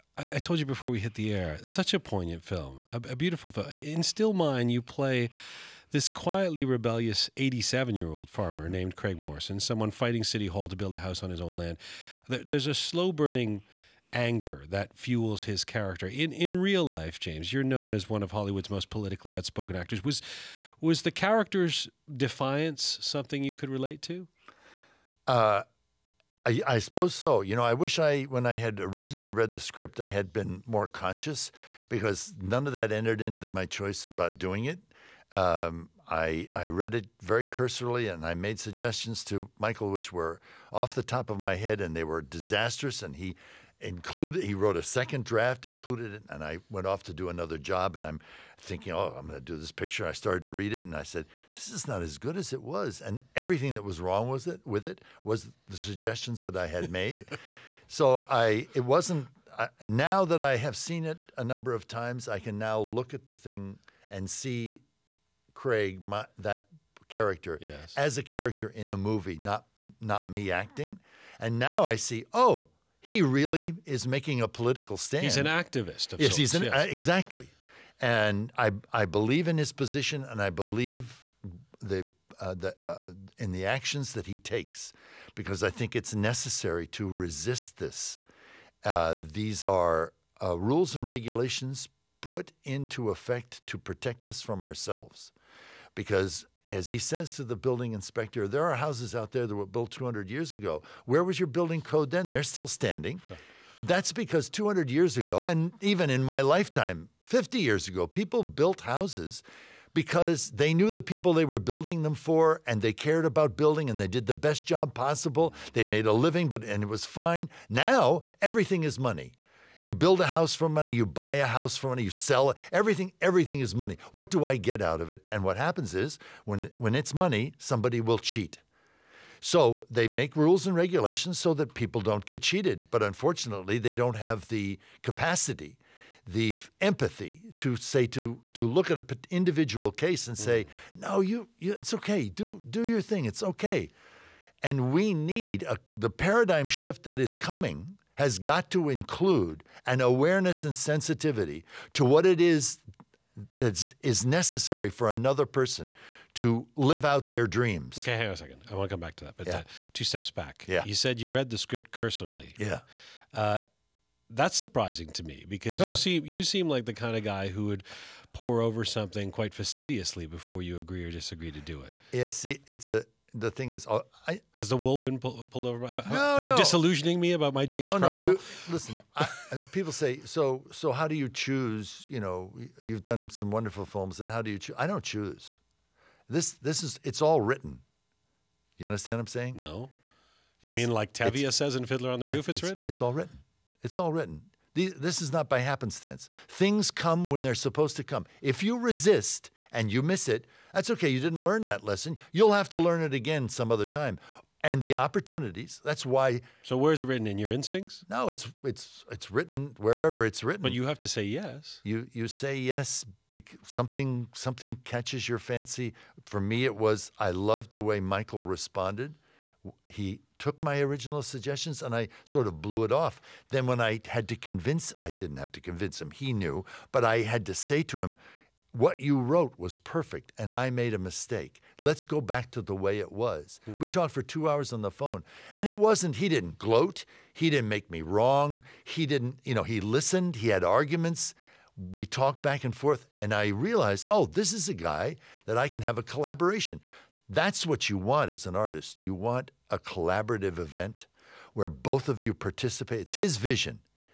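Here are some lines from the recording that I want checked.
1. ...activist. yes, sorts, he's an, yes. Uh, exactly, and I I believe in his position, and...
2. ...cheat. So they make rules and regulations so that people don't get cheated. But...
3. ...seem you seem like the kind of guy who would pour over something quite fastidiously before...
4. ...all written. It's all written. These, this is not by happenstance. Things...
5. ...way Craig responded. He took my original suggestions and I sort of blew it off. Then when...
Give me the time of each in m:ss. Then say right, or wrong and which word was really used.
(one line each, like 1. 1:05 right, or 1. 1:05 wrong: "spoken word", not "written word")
1. 1:15 right
2. 2:08 right
3. 2:45 right
4. 3:13 right
5. 3:37 wrong: "Michael", not "Craig".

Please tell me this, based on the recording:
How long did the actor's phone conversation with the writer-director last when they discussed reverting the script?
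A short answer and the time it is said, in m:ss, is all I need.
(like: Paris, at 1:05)
2 hours, at 3:54.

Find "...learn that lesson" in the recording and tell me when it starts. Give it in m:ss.
3:21.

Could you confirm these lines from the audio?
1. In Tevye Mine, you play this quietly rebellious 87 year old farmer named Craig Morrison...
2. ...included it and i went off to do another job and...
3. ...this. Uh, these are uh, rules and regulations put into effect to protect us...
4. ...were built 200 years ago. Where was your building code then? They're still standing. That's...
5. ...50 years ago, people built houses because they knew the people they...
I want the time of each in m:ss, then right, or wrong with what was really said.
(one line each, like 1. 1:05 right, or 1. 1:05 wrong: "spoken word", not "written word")
1. 0:03 wrong: "Still", not "Tevye"
2. 0:45 right
3. 1:27 right
4. 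1:39 right
5. 1:47 right.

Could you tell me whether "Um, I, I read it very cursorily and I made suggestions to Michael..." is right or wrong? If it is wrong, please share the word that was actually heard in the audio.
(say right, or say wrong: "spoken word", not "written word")
right.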